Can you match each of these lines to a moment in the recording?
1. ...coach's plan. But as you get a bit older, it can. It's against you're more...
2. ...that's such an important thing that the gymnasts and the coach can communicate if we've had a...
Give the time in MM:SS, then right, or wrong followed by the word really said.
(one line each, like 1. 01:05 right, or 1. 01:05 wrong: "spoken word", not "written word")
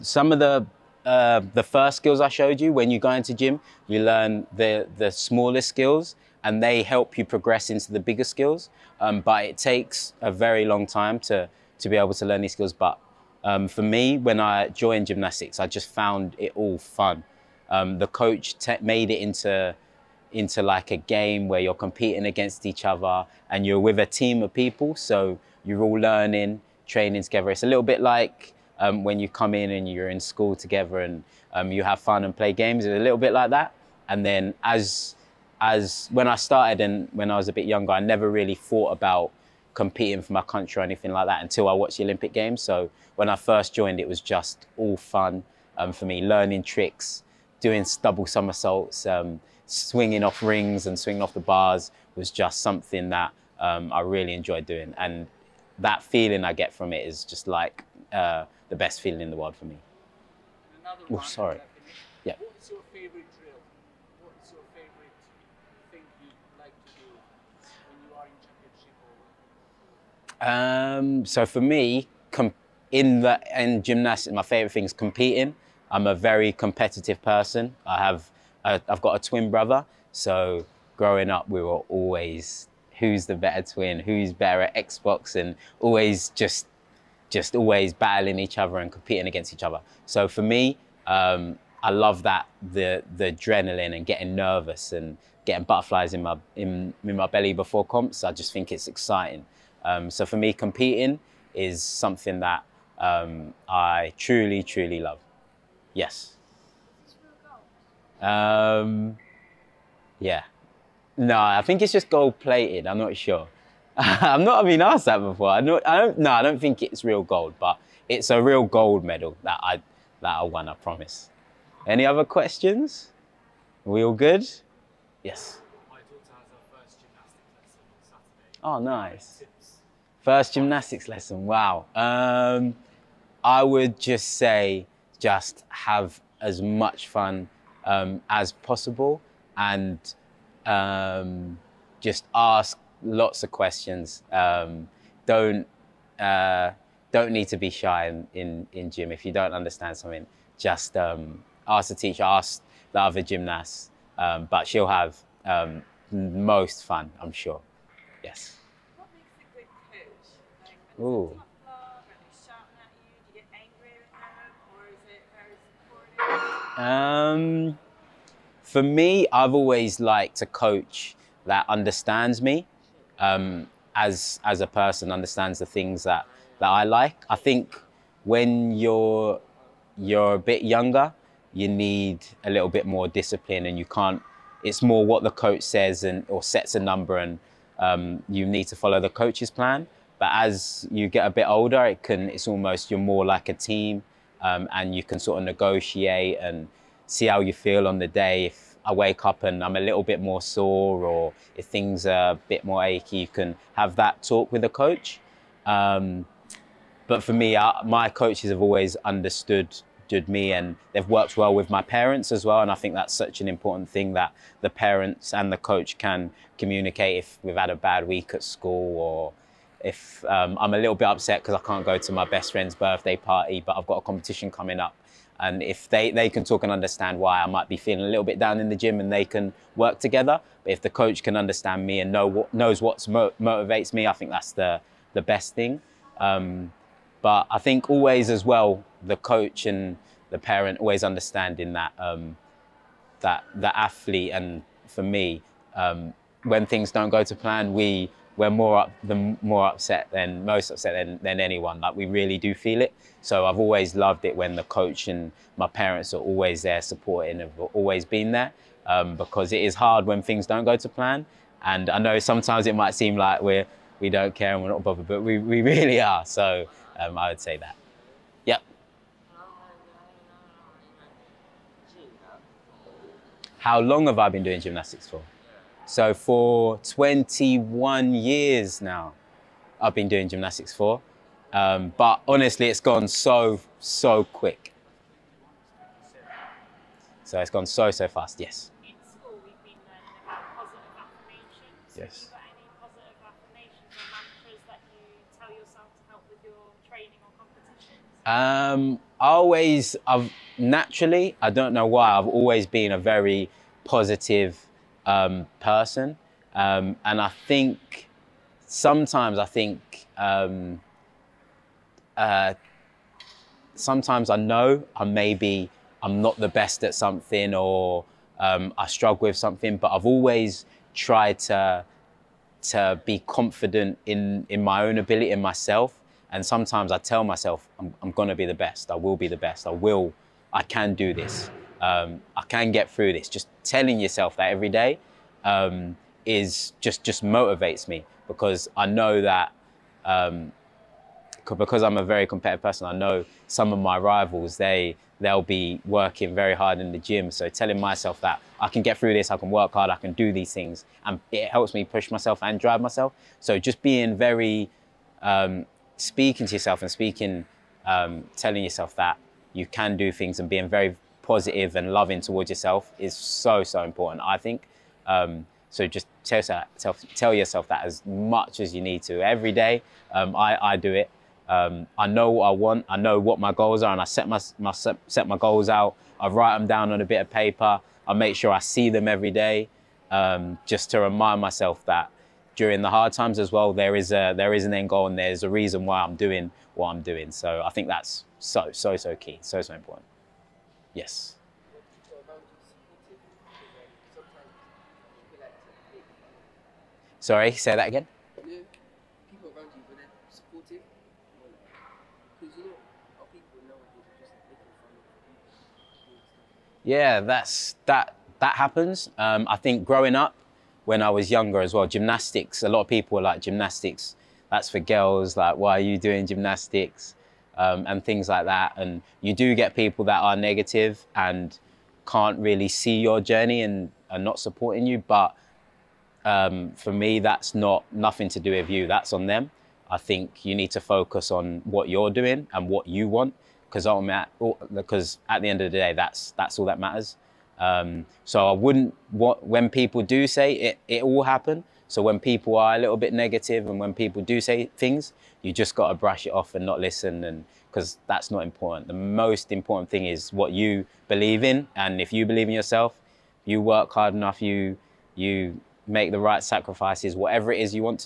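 1. 03:09 wrong: "almost", not "against"
2. 03:32 wrong: "parents", not "gymnasts".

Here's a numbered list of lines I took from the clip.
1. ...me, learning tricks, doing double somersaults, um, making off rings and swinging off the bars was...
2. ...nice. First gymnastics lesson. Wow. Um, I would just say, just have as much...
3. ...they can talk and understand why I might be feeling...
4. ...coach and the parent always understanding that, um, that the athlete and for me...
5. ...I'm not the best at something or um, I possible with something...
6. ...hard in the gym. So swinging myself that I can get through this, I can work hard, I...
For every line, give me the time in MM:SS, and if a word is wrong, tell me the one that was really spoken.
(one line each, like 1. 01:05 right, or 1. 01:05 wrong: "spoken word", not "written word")
1. 00:46 wrong: "swinging", not "making"
2. 02:08 right
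3. 03:46 right
4. 03:59 right
5. 05:16 wrong: "struggle", not "possible"
6. 05:46 wrong: "telling", not "swinging".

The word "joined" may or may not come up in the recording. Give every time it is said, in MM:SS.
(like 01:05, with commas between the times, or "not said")
00:14, 00:43.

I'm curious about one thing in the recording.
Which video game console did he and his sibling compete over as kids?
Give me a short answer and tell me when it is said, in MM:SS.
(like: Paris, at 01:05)
Xbox, at 01:24.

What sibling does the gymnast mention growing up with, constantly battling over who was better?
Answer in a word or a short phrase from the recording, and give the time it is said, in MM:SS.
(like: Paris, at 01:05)
Twin brother, at 01:19.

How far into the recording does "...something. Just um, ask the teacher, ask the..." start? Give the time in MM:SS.
02:29.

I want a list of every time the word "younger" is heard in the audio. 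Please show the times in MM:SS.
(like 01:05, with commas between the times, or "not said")
00:37, 03:00, 06:51.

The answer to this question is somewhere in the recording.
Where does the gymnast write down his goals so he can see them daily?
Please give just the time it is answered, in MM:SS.
06:17.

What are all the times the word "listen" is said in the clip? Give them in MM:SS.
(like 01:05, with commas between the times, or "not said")
07:26.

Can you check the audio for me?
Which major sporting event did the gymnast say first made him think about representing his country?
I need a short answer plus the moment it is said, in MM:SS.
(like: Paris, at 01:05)
Olympic Games, at 00:42.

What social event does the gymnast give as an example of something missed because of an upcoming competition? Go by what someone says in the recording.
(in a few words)
Best friend's birthday party.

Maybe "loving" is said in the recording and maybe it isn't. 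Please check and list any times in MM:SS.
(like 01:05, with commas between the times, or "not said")
06:01.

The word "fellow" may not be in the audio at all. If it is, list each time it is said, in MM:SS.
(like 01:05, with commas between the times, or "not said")
not said.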